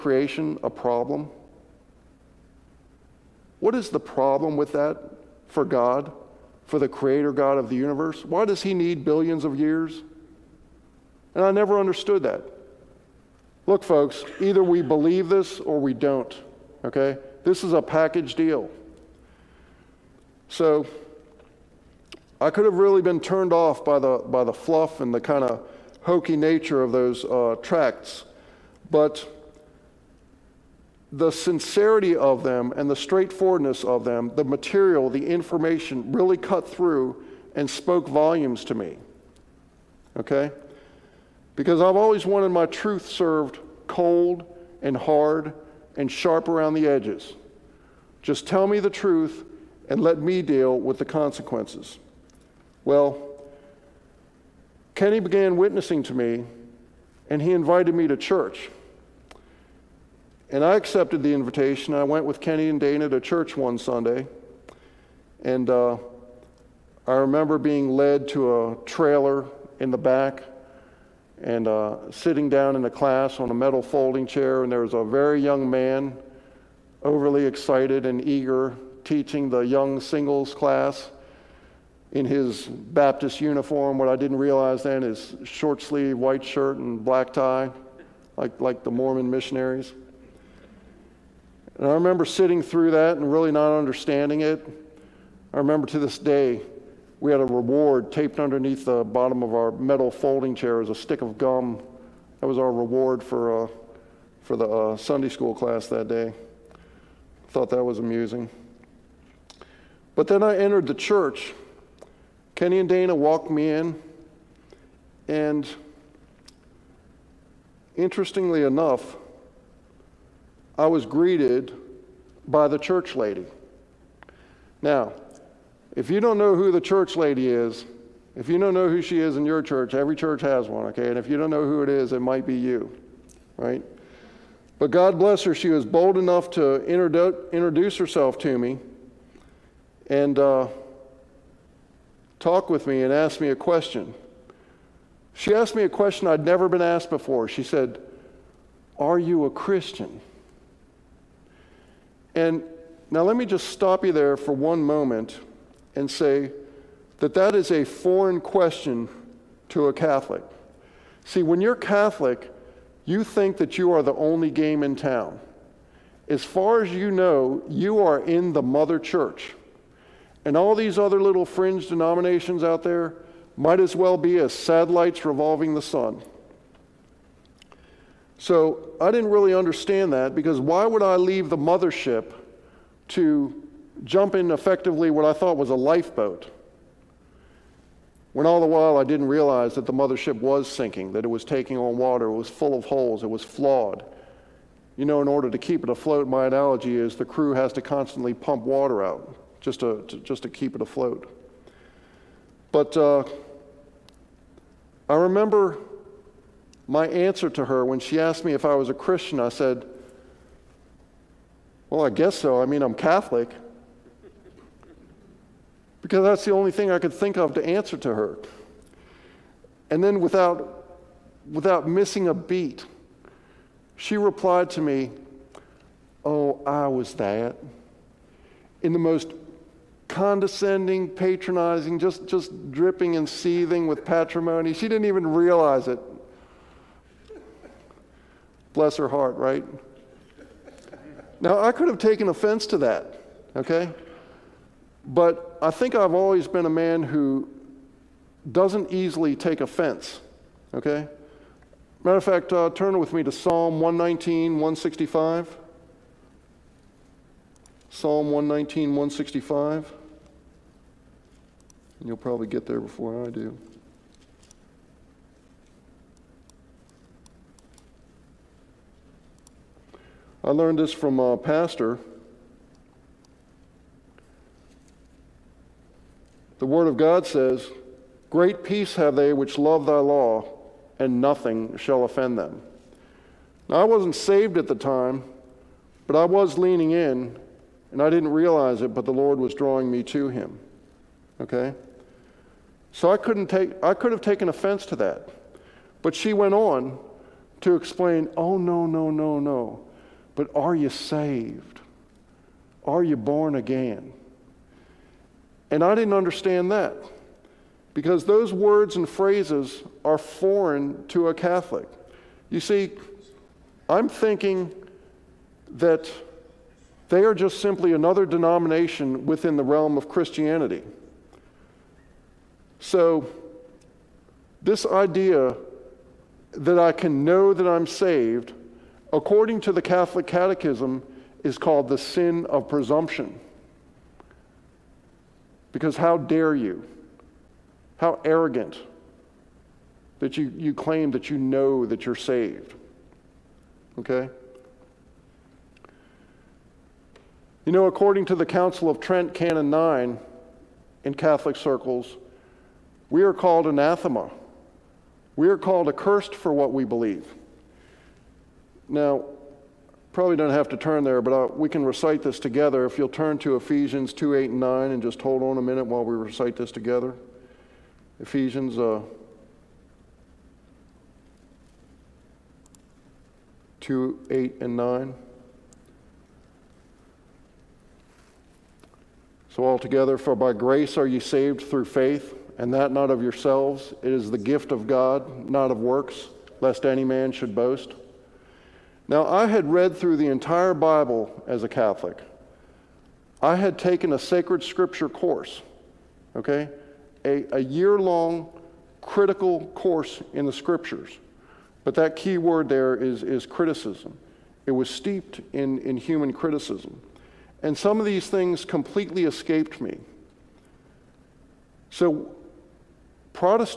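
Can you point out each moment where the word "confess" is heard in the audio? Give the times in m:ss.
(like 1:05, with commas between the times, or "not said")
not said.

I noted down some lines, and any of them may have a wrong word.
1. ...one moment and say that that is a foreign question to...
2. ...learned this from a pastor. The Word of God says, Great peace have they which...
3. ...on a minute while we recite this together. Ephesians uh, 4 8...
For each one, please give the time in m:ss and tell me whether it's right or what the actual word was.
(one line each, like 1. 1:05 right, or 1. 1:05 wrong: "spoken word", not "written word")
1. 2:34 right
2. 4:30 right
3. 6:05 wrong: "2", not "4".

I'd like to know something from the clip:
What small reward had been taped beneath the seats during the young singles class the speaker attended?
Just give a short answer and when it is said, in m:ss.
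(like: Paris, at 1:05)
A stick of gum, at 1:40.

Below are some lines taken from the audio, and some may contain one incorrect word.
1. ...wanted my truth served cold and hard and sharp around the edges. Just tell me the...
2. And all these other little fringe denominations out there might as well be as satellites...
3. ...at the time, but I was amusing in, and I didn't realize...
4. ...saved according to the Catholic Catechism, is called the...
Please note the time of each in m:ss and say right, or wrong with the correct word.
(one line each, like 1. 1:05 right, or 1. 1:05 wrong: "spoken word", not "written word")
1. 0:42 right
2. 2:50 right
3. 4:44 wrong: "leaning", not "amusing"
4. 5:27 right.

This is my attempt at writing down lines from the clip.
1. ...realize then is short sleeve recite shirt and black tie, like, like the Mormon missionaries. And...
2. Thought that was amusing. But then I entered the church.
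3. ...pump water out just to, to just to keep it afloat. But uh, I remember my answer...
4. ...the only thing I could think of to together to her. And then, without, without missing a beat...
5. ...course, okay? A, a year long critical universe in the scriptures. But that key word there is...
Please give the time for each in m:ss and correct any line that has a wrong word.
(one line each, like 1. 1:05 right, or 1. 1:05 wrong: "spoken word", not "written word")
1. 1:24 wrong: "white", not "recite"
2. 1:47 right
3. 3:18 right
4. 3:36 wrong: "answer", not "together"
5. 6:35 wrong: "course", not "universe".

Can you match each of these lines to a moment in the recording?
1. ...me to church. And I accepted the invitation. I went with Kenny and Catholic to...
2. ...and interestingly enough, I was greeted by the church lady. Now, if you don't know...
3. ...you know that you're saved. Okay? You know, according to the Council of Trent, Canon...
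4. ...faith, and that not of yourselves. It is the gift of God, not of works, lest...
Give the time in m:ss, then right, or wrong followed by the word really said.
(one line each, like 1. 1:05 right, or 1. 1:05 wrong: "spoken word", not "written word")
1. 0:57 wrong: "Dana", not "Catholic"
2. 1:55 right
3. 5:41 right
4. 6:21 right.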